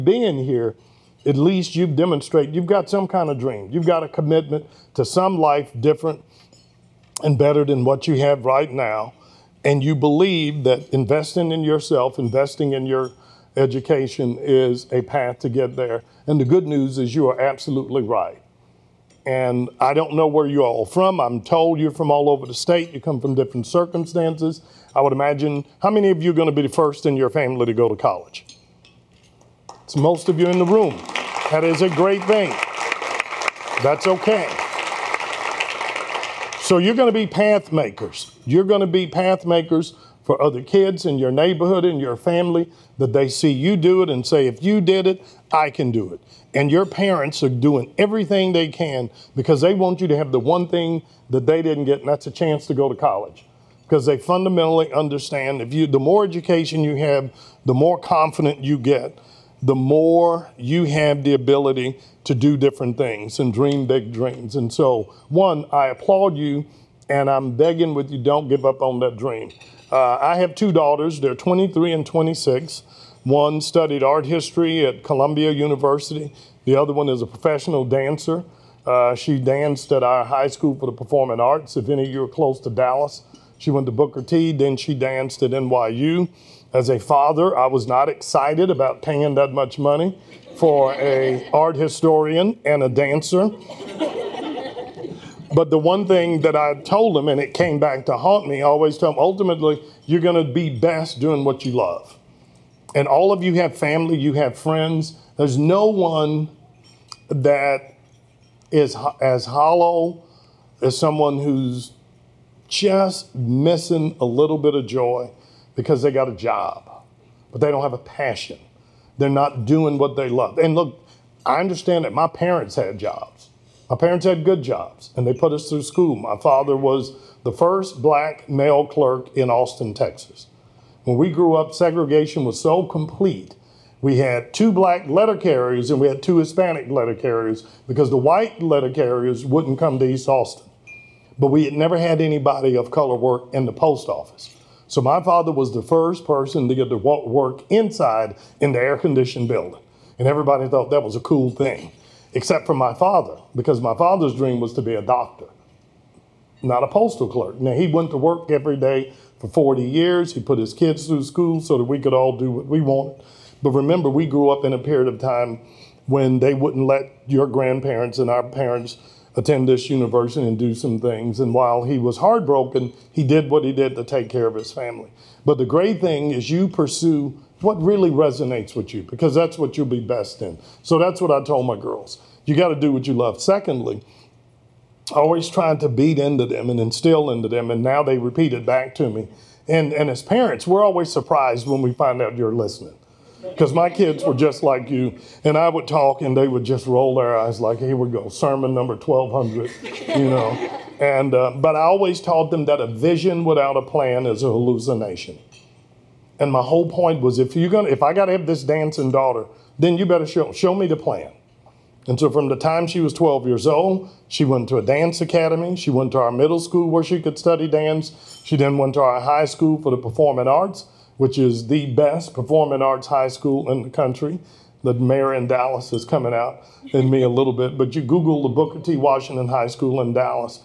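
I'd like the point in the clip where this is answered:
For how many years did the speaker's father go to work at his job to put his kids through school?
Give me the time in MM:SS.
02:39.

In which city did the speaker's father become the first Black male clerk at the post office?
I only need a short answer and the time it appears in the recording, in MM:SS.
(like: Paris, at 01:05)
Austin, Texas, at 02:09.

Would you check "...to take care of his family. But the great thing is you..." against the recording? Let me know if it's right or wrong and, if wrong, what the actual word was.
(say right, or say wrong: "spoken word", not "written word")
right.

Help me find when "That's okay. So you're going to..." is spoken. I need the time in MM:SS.
00:33.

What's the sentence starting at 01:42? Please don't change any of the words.
And all of you have family, you have friends.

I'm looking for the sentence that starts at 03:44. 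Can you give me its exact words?
The mayor in Dallas is coming out in me a little bit, but you Google the Booker T.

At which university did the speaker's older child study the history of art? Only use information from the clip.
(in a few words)
Columbia University.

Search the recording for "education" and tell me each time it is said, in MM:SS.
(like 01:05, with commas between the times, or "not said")
00:13, 00:56.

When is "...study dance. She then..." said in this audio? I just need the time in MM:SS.
03:37.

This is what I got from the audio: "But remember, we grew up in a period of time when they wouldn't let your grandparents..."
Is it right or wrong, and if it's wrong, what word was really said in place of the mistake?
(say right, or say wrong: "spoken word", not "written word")
right.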